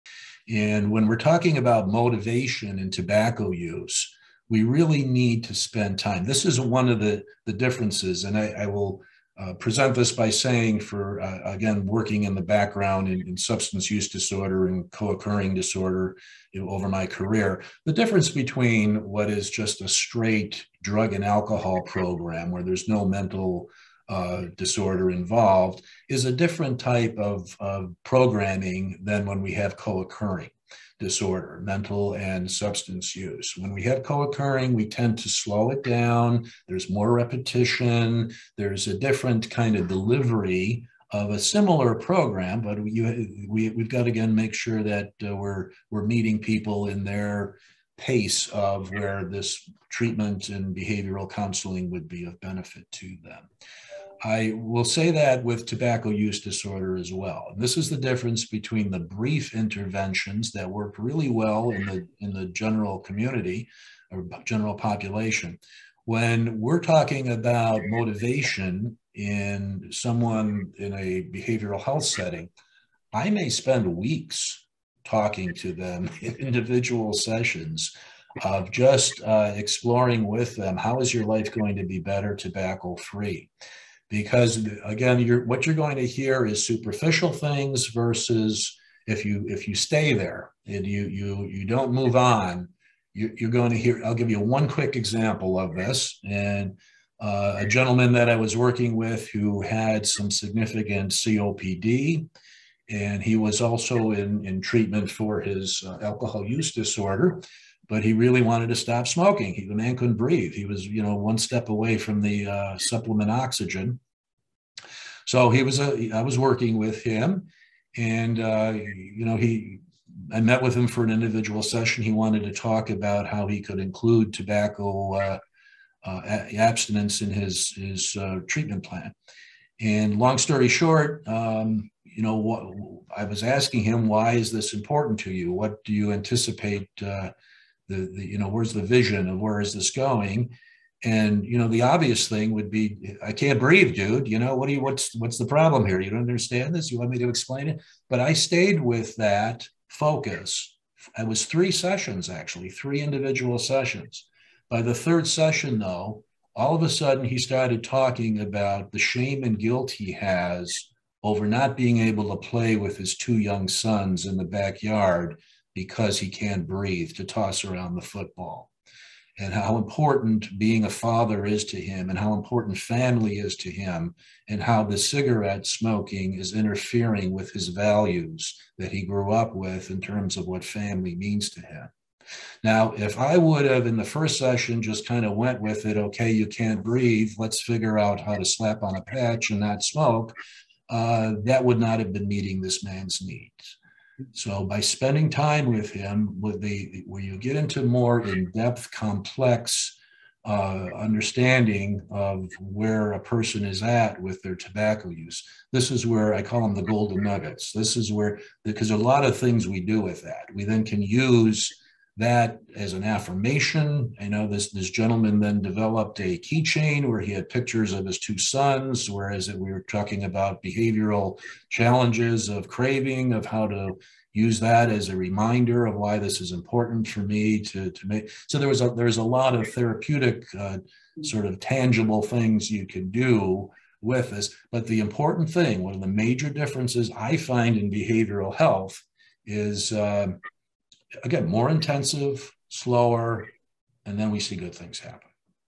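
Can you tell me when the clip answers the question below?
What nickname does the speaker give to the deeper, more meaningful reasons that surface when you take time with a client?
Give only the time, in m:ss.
3:26.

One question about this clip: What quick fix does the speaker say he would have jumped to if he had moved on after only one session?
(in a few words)
a patch.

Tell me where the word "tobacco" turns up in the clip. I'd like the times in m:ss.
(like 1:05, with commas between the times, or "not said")
0:02, 0:55, 1:22, 2:04, 3:24.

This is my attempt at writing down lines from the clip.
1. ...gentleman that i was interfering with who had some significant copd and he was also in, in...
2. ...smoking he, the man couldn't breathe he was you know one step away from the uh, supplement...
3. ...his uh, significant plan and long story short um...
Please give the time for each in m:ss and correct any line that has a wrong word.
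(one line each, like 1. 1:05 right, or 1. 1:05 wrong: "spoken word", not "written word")
1. 1:37 wrong: "working", not "interfering"
2. 1:49 right
3. 2:07 wrong: "treatment", not "significant".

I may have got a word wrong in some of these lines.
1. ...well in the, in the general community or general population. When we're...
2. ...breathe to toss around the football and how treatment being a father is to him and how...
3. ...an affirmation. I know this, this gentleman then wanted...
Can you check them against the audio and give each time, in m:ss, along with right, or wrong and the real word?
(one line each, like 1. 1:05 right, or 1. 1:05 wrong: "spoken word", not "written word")
1. 1:01 right
2. 2:46 wrong: "important", not "treatment"
3. 3:32 wrong: "developed", not "wanted".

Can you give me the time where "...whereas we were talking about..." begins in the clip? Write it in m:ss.
3:39.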